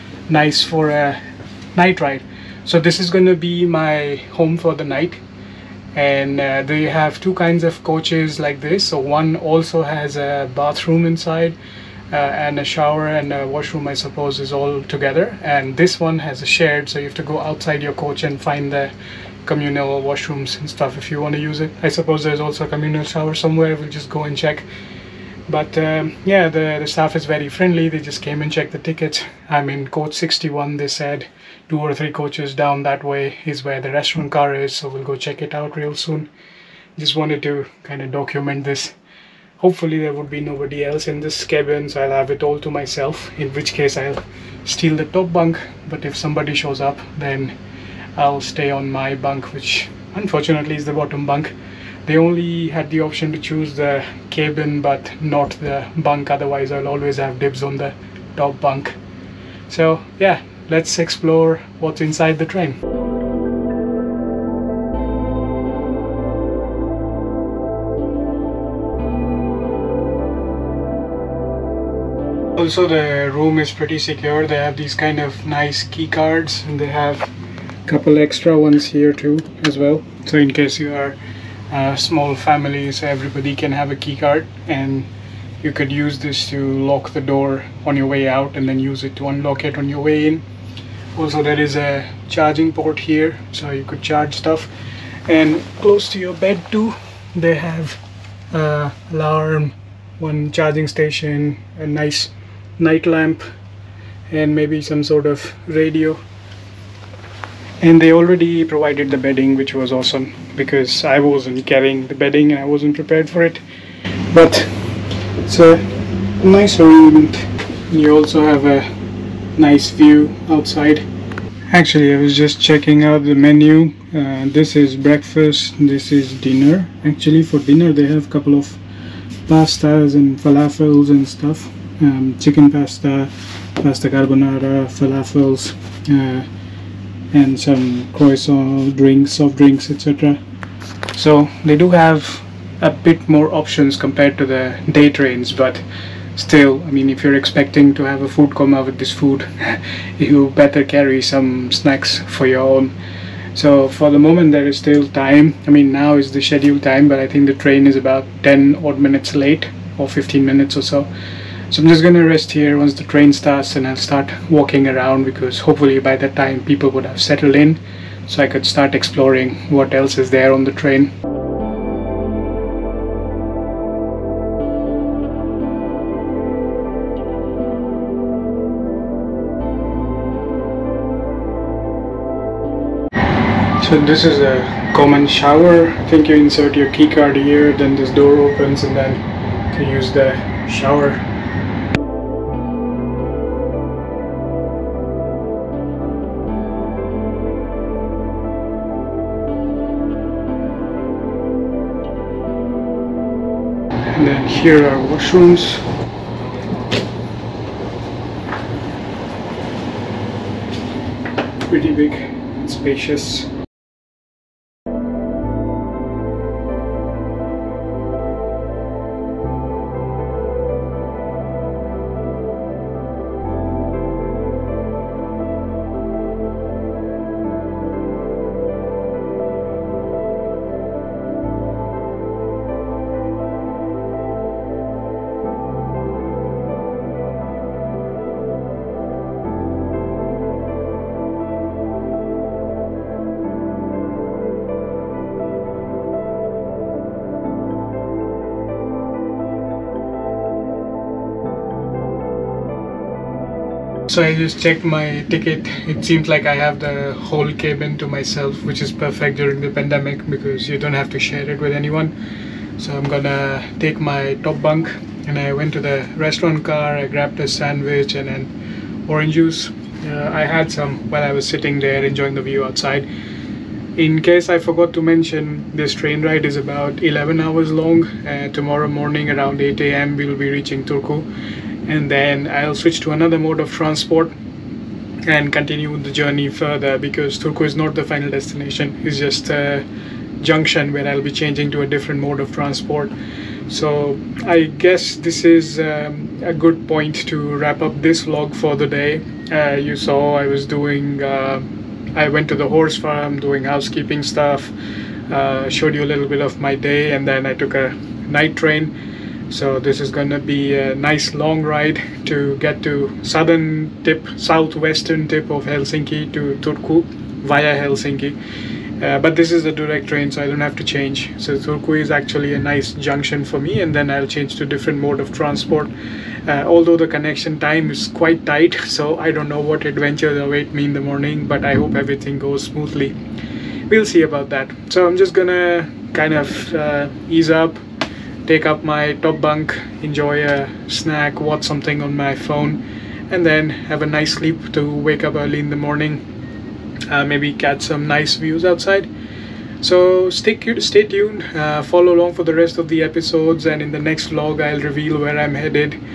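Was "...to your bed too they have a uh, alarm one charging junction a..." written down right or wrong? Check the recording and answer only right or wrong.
wrong.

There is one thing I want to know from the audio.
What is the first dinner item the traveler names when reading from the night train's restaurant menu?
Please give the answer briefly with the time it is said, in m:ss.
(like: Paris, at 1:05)
chicken pasta, at 2:12.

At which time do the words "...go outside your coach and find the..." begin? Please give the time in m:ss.
0:17.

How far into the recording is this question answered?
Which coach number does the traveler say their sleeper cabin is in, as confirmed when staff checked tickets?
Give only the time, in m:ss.
0:29.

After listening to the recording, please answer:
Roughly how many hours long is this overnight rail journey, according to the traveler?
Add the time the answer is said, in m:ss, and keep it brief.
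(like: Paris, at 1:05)
11 hours, at 4:37.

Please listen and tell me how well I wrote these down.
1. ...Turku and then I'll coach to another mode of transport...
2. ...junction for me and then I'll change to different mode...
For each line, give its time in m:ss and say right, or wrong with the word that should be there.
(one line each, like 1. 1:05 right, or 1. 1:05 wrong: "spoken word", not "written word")
1. 4:40 wrong: "switch", not "coach"
2. 5:22 right.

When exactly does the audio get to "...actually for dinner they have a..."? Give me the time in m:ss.
2:07.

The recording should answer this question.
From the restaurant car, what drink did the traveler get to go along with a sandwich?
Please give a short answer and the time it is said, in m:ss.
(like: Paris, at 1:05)
orange juice, at 4:29.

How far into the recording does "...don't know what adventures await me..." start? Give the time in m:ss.
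5:29.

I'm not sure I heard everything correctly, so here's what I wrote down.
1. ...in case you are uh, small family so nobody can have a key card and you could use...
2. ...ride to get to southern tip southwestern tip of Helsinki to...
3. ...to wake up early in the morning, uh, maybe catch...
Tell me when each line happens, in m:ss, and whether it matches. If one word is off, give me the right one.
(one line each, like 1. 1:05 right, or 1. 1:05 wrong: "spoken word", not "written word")
1. 1:20 wrong: "everybody", not "nobody"
2. 5:11 right
3. 5:44 right.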